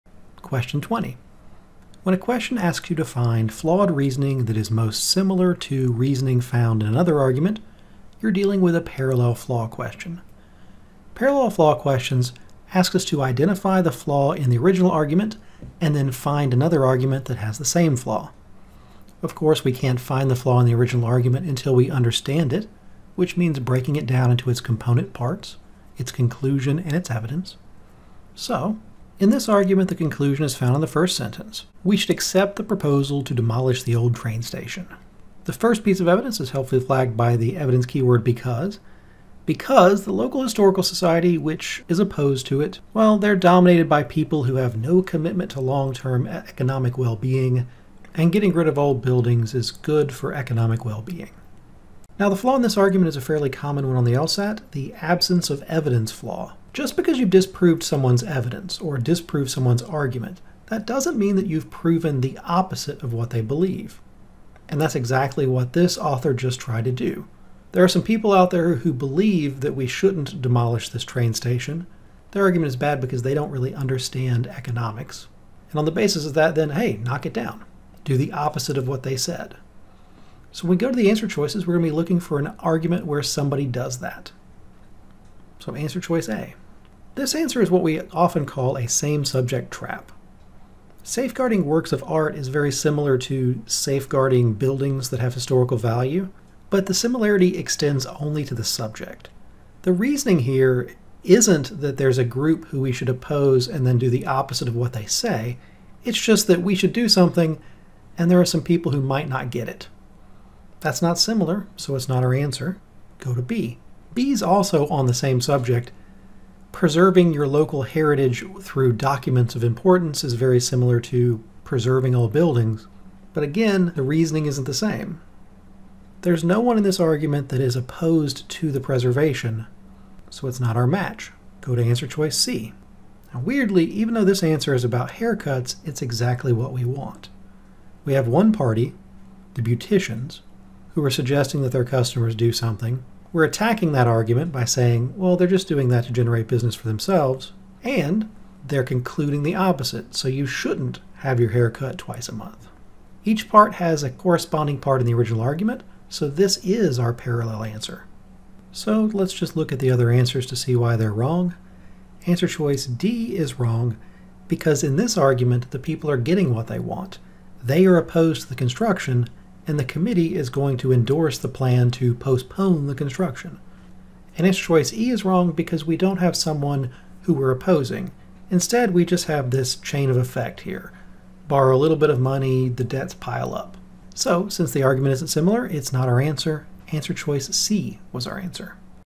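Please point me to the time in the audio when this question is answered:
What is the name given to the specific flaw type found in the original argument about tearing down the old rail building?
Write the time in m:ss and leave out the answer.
0:55.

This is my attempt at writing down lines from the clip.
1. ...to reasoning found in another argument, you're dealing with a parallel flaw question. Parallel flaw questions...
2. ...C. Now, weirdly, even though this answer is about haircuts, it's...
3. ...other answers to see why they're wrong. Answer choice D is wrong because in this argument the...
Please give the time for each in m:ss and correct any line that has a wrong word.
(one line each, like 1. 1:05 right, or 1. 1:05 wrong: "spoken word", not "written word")
1. 0:05 right
2. 2:12 right
3. 2:39 right.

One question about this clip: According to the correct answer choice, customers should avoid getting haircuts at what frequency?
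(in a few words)
twice a month.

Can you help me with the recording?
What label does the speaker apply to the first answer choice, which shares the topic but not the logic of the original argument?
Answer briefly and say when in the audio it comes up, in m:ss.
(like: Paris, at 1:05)
same subject trap, at 1:28.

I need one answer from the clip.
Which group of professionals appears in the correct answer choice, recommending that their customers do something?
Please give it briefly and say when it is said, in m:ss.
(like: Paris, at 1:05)
beauticians, at 2:19.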